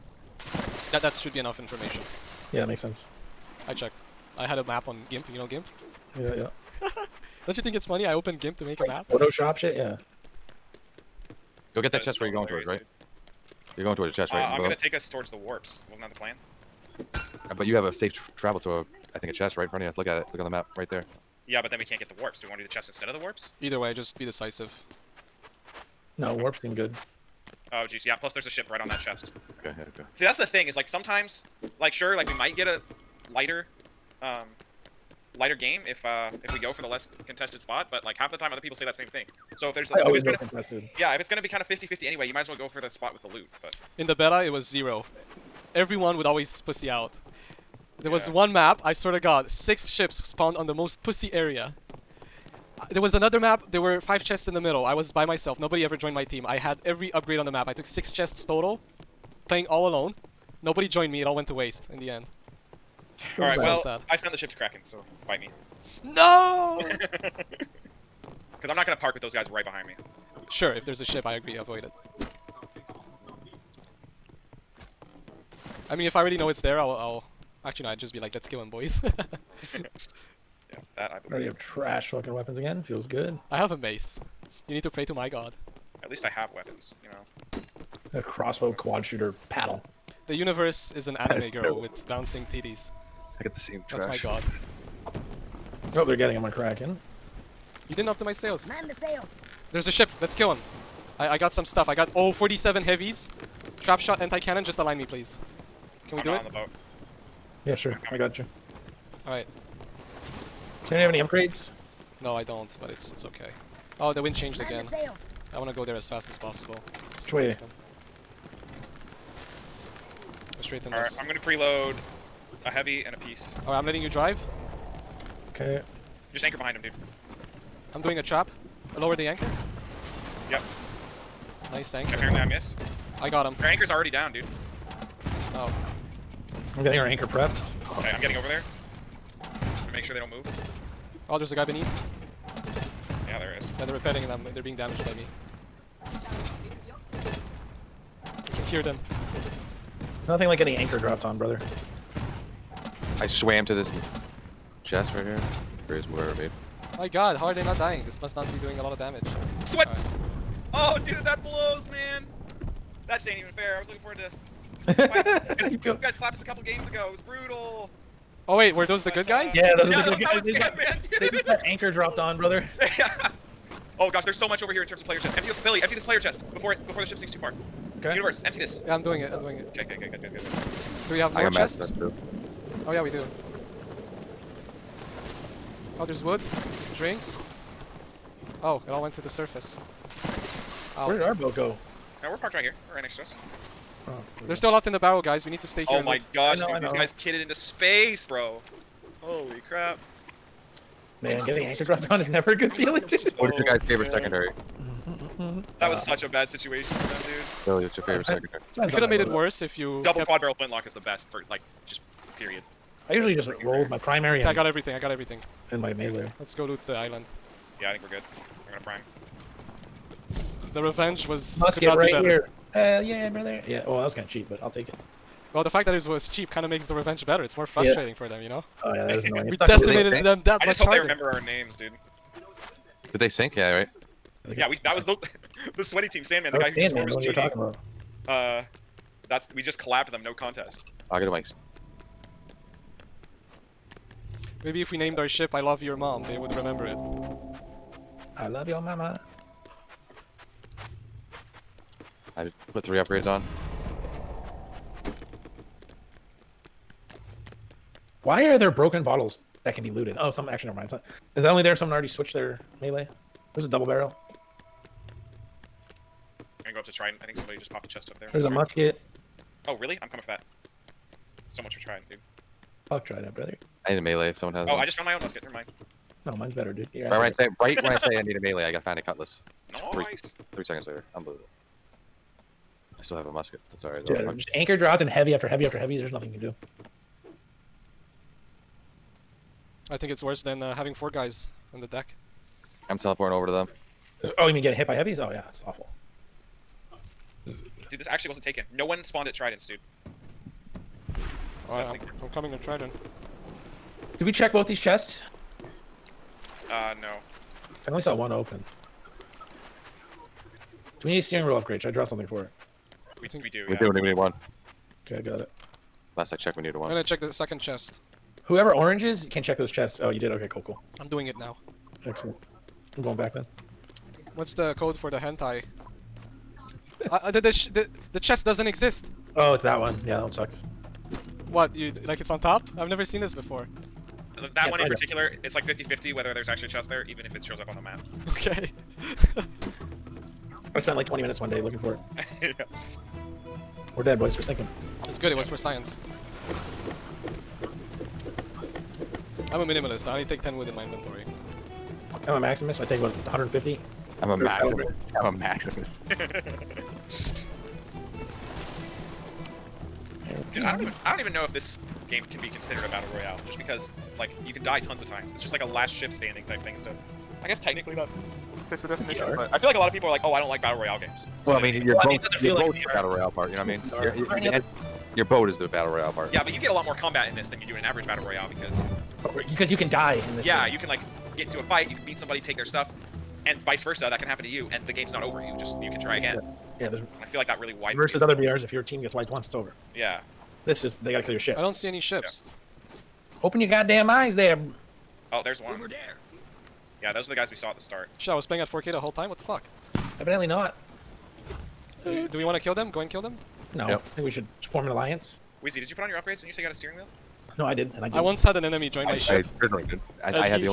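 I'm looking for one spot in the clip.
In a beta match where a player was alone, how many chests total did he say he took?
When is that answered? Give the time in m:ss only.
0:57.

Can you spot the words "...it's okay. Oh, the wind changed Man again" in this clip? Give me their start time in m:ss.
1:53.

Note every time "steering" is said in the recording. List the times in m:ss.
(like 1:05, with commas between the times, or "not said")
5:11, 6:46.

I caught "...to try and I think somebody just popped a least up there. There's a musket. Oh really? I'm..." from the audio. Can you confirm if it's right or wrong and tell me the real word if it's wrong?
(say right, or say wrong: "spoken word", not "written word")
wrong: "chest", not "least".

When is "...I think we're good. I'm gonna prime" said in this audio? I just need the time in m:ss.
3:37.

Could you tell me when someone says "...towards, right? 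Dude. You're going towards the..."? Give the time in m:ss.
0:12.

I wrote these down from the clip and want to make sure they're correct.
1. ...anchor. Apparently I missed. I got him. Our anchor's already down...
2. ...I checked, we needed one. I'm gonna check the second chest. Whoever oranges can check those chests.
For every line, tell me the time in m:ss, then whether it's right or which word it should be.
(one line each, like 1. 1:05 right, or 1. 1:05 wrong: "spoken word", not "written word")
1. 2:11 right
2. 5:16 right.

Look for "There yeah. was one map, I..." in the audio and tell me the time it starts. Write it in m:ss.
0:48.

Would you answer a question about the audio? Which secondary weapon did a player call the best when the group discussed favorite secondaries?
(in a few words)
quad barrel flintlock.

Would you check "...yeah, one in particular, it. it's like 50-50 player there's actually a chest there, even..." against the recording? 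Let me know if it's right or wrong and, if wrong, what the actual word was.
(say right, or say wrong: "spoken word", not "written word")
wrong: "whether", not "player".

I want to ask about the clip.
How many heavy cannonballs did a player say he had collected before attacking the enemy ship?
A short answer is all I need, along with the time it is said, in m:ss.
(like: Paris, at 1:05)
47, at 1:42.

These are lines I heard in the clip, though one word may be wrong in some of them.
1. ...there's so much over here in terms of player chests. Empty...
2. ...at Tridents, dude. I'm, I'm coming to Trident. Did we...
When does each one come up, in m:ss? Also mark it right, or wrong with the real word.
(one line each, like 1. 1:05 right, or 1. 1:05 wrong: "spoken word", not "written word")
1. 2:54 right
2. 4:59 right.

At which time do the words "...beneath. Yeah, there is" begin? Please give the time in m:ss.
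2:21.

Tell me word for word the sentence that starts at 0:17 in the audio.
Uh, but you have a safe tr travel to a, I think, a chest right in front of you.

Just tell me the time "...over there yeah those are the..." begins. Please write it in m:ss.
6:35.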